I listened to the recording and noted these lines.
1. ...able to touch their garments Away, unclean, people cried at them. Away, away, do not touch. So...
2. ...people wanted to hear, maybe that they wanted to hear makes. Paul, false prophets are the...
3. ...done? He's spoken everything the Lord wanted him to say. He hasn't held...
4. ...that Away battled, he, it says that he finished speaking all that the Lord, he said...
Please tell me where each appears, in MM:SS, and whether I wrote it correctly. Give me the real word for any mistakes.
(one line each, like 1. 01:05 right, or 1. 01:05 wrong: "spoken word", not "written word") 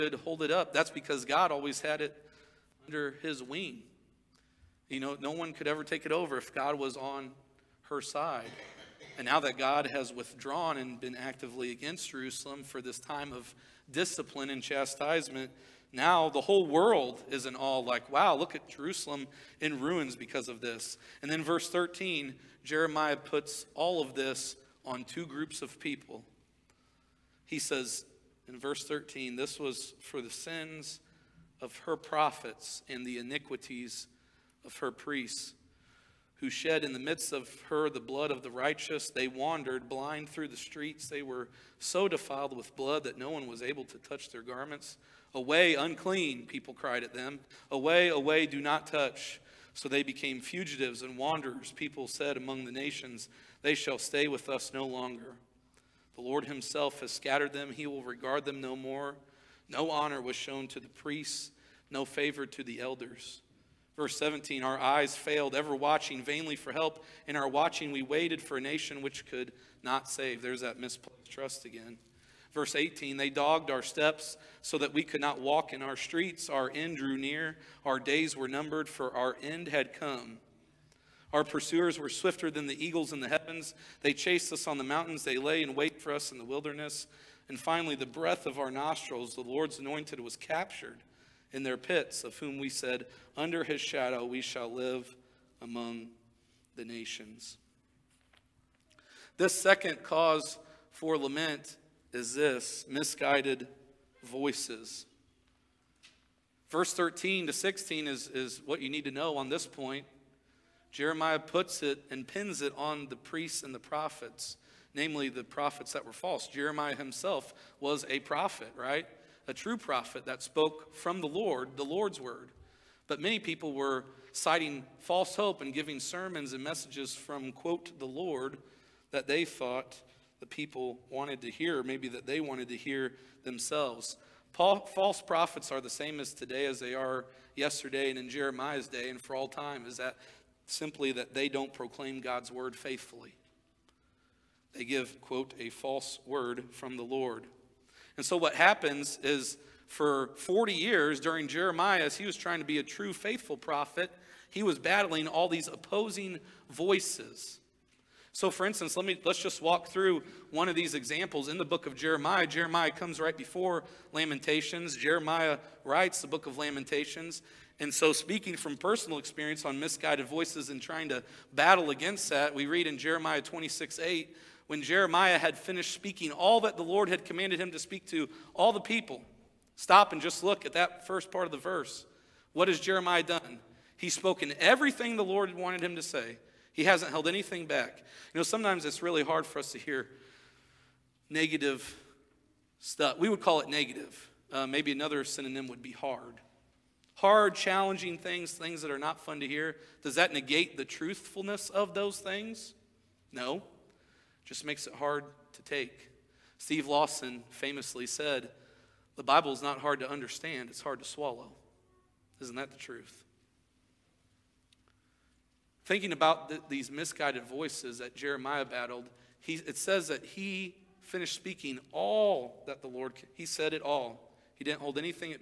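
1. 00:43 right
2. 02:10 wrong: "themselves", not "makes"
3. 03:03 right
4. 03:37 wrong: "Jeremiah", not "Away".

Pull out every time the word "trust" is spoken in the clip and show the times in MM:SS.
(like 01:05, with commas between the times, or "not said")
01:11.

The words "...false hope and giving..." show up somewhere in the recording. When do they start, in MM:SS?
02:05.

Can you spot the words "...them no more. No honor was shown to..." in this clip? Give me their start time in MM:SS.
00:58.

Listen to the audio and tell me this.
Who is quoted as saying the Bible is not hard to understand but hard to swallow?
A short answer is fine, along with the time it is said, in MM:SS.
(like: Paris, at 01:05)
Steve Lawson, at 03:26.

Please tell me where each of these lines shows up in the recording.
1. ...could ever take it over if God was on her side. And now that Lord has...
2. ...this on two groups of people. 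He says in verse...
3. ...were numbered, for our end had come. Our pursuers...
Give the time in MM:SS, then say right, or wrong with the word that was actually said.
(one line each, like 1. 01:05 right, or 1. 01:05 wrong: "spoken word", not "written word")
1. 00:05 wrong: "God", not "Lord"
2. 00:24 right
3. 01:18 right.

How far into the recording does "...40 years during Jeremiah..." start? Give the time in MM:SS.
02:30.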